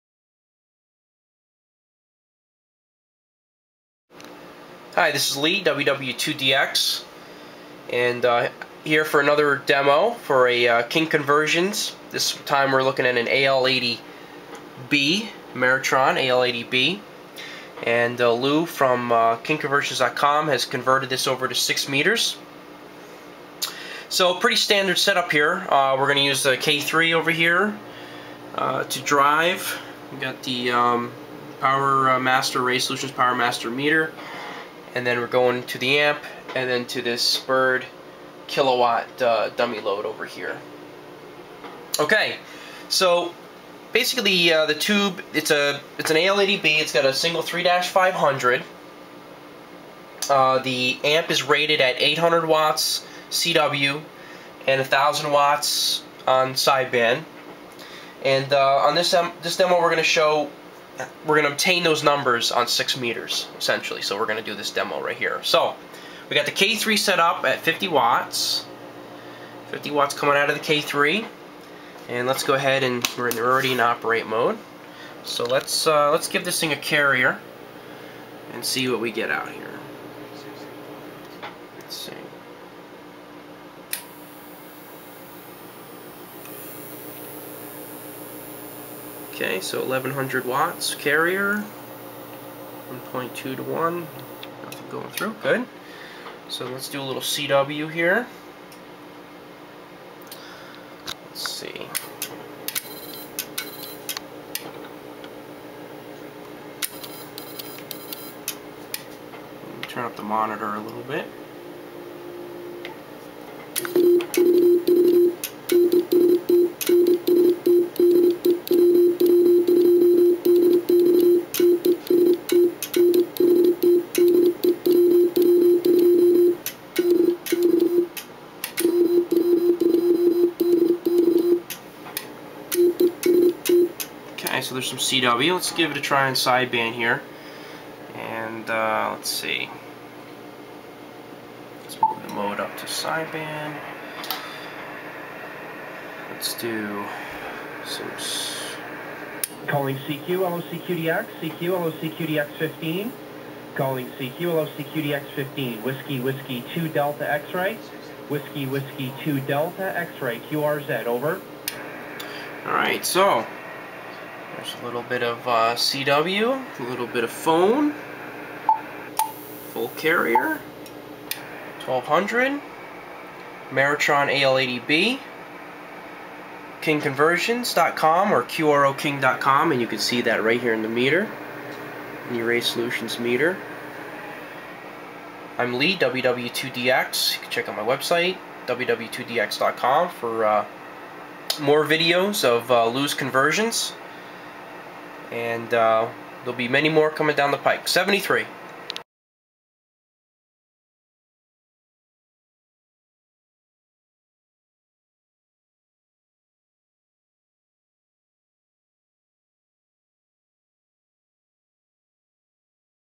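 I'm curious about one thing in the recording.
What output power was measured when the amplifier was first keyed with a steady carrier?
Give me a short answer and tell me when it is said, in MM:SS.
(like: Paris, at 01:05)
1100 watts, at 01:29.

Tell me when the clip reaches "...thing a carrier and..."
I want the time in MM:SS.
01:16.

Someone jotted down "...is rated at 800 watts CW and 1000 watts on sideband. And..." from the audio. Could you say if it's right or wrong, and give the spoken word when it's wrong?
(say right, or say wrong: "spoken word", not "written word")
right.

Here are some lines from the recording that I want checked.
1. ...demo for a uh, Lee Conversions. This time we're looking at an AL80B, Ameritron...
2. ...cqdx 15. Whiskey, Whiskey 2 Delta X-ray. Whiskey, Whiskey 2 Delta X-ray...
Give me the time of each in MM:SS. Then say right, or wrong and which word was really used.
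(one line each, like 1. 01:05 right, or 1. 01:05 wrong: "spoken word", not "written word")
1. 00:09 wrong: "King", not "Lee"
2. 02:34 right.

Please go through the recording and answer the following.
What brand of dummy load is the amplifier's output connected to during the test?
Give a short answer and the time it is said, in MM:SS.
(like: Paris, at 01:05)
Bird, at 00:37.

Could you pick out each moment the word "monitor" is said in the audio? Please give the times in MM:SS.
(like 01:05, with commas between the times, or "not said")
01:50.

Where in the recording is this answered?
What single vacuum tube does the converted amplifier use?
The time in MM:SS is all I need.
00:47.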